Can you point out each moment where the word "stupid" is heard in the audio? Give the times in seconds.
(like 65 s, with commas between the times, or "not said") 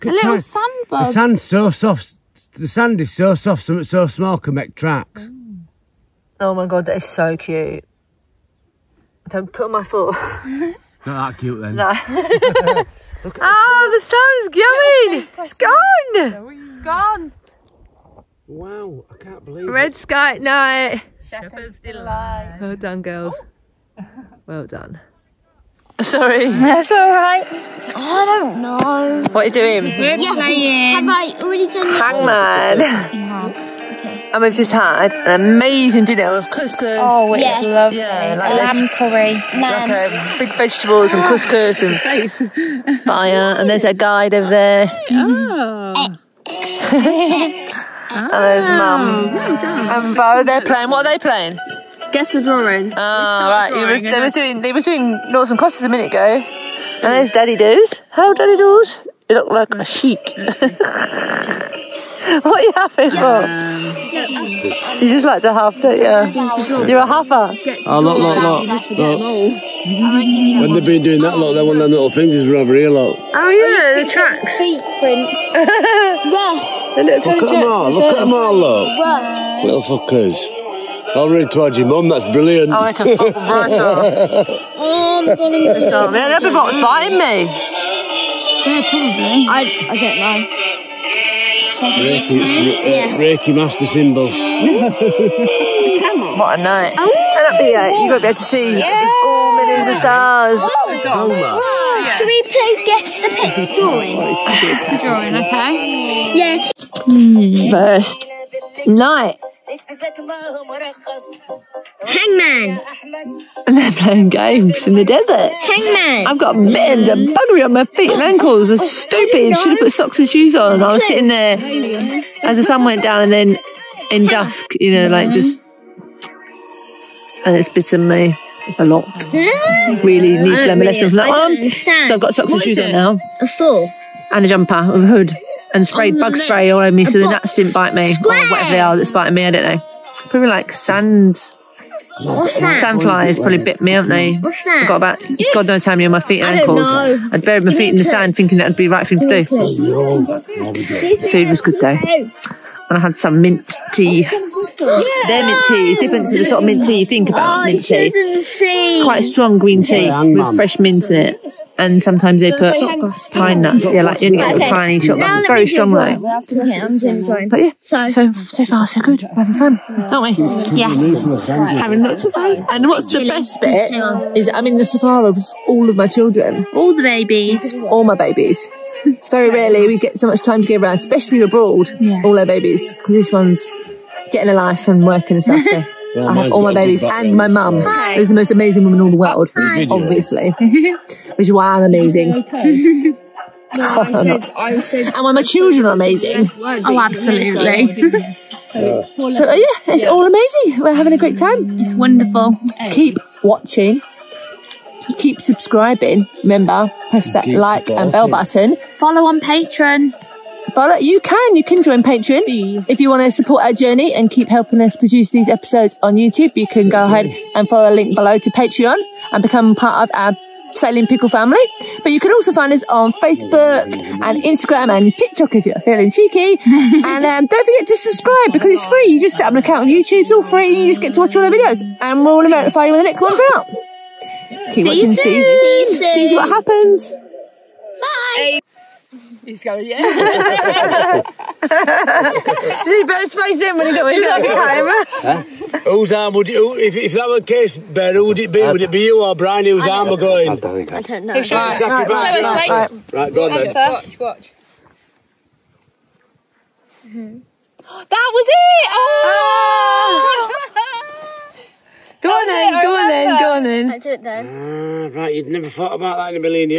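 118 s.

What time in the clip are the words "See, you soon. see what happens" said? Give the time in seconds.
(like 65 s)
235 s.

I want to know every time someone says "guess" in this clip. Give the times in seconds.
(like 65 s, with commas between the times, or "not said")
52 s, 102 s.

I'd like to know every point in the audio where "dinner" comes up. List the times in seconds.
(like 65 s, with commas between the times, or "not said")
36 s.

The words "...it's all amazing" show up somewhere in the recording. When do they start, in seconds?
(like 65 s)
199 s.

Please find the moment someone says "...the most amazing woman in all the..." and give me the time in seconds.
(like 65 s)
188 s.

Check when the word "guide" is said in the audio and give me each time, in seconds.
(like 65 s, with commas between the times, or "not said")
43 s.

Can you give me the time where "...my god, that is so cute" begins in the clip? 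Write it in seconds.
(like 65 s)
6 s.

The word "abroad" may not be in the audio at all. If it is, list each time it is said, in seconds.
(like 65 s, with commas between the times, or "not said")
181 s.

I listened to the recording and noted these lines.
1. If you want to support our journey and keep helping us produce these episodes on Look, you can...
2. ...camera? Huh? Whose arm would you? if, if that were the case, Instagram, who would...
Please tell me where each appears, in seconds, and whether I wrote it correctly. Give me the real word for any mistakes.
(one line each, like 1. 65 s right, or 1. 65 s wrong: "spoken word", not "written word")
1. 212 s wrong: "YouTube", not "Look"
2. 244 s wrong: "Ben", not "Instagram".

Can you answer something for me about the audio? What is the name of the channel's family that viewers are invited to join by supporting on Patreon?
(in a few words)
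Sailing Pickle.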